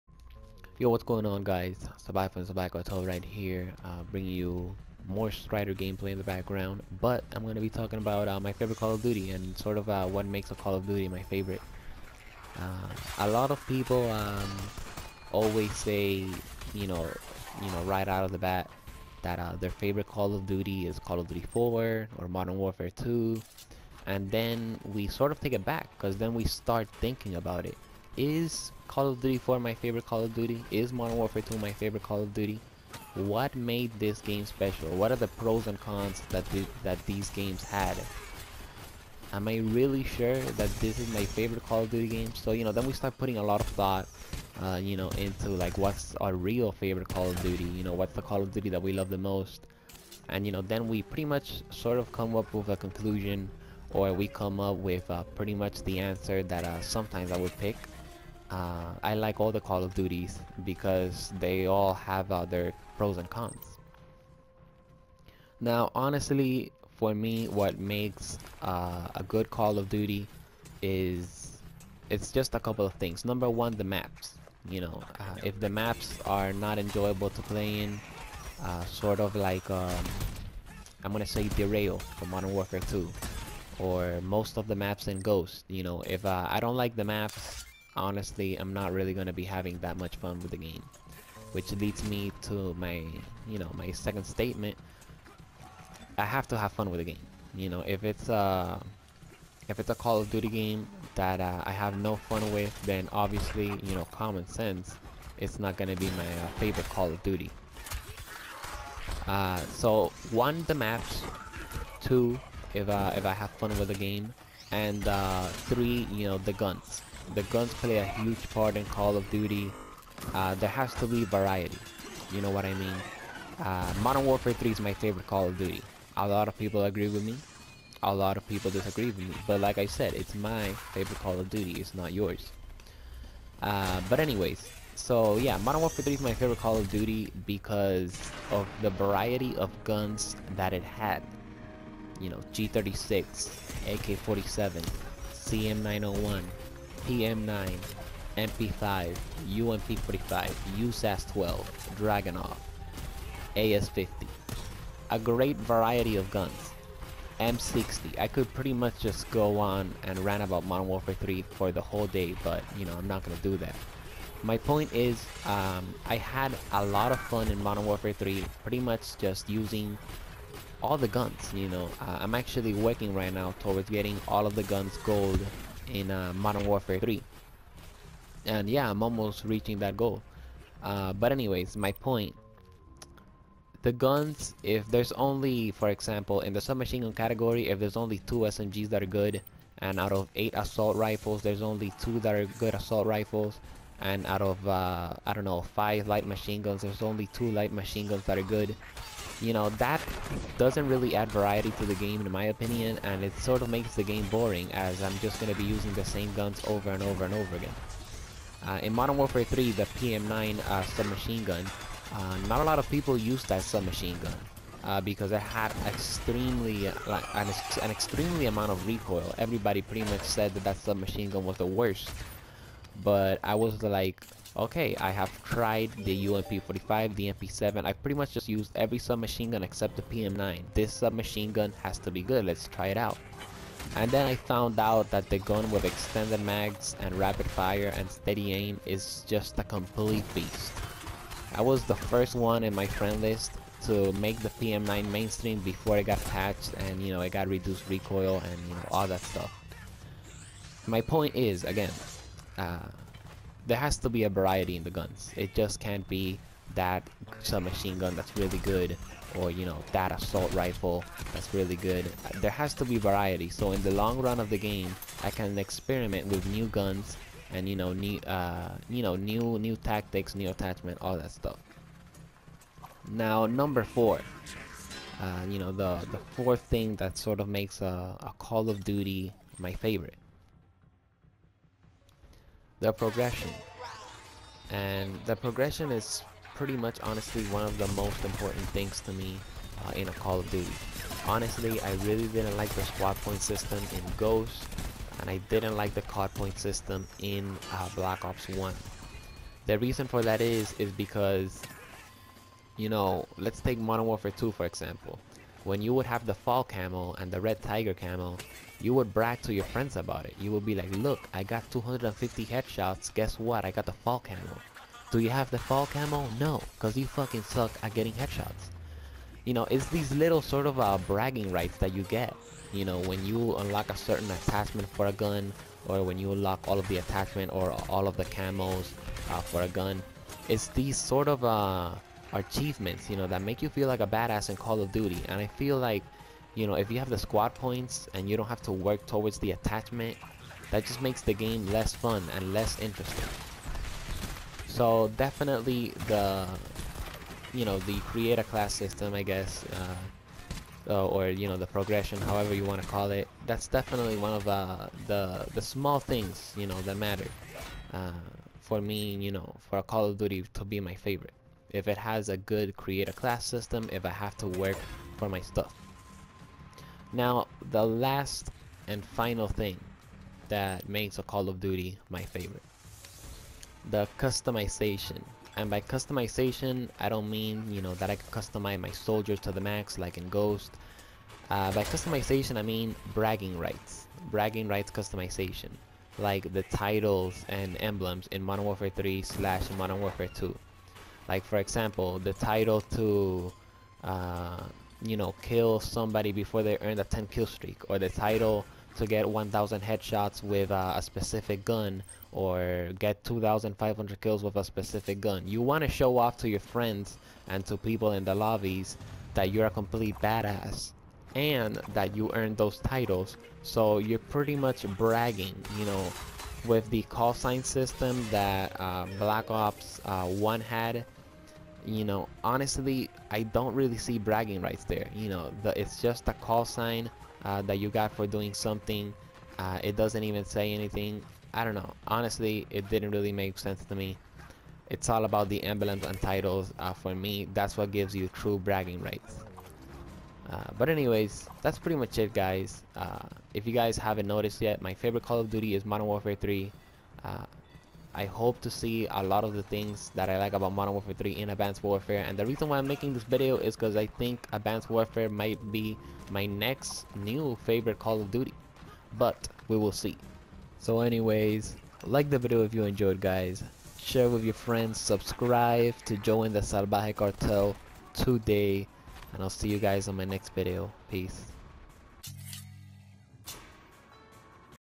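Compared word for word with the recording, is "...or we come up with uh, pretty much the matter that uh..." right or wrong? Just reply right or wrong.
wrong.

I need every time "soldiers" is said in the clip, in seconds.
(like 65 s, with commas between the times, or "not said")
378 s.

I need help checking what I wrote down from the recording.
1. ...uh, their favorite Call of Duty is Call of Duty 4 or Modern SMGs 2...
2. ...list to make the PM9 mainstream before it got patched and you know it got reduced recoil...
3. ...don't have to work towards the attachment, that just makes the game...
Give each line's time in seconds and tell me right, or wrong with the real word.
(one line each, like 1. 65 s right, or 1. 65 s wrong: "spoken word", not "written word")
1. 19 s wrong: "Warfare", not "SMGs"
2. 243 s right
3. 338 s right.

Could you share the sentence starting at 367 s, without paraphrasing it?
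Now, the last and final thing that makes a Call of Duty my favorite.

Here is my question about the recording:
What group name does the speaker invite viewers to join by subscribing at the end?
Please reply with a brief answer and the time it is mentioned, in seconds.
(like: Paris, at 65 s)
Salvaje Cartel, at 466 s.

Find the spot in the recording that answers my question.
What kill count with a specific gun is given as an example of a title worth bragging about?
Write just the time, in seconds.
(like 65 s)
403 s.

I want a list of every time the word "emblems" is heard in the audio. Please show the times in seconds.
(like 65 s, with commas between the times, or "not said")
387 s, 435 s.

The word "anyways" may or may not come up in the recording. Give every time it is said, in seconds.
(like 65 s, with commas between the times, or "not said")
134 s, 181 s, 440 s, 461 s.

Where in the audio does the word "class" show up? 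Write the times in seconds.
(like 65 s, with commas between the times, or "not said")
347 s, 362 s.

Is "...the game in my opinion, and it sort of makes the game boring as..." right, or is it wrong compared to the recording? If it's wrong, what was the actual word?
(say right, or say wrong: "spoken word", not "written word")
right.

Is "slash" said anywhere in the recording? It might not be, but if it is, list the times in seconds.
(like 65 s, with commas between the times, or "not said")
389 s.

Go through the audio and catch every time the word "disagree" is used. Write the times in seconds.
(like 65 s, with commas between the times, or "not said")
128 s.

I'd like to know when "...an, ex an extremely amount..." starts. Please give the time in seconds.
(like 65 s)
217 s.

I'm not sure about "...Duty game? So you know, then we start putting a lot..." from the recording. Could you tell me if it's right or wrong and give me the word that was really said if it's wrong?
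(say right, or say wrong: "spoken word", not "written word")
right.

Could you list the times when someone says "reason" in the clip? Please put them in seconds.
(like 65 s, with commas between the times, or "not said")
299 s, 452 s.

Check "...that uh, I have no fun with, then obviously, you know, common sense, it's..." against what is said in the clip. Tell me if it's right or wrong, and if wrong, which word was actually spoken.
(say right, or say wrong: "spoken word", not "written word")
right.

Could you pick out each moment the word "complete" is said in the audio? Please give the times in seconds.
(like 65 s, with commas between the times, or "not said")
239 s, 409 s.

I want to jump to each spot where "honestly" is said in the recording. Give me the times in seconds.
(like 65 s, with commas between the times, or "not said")
65 s, 87 s, 287 s, 291 s, 422 s, 432 s.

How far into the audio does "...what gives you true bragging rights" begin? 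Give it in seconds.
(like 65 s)
437 s.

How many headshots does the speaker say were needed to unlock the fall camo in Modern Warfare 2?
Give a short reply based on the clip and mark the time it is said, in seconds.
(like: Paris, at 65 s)
250, at 311 s.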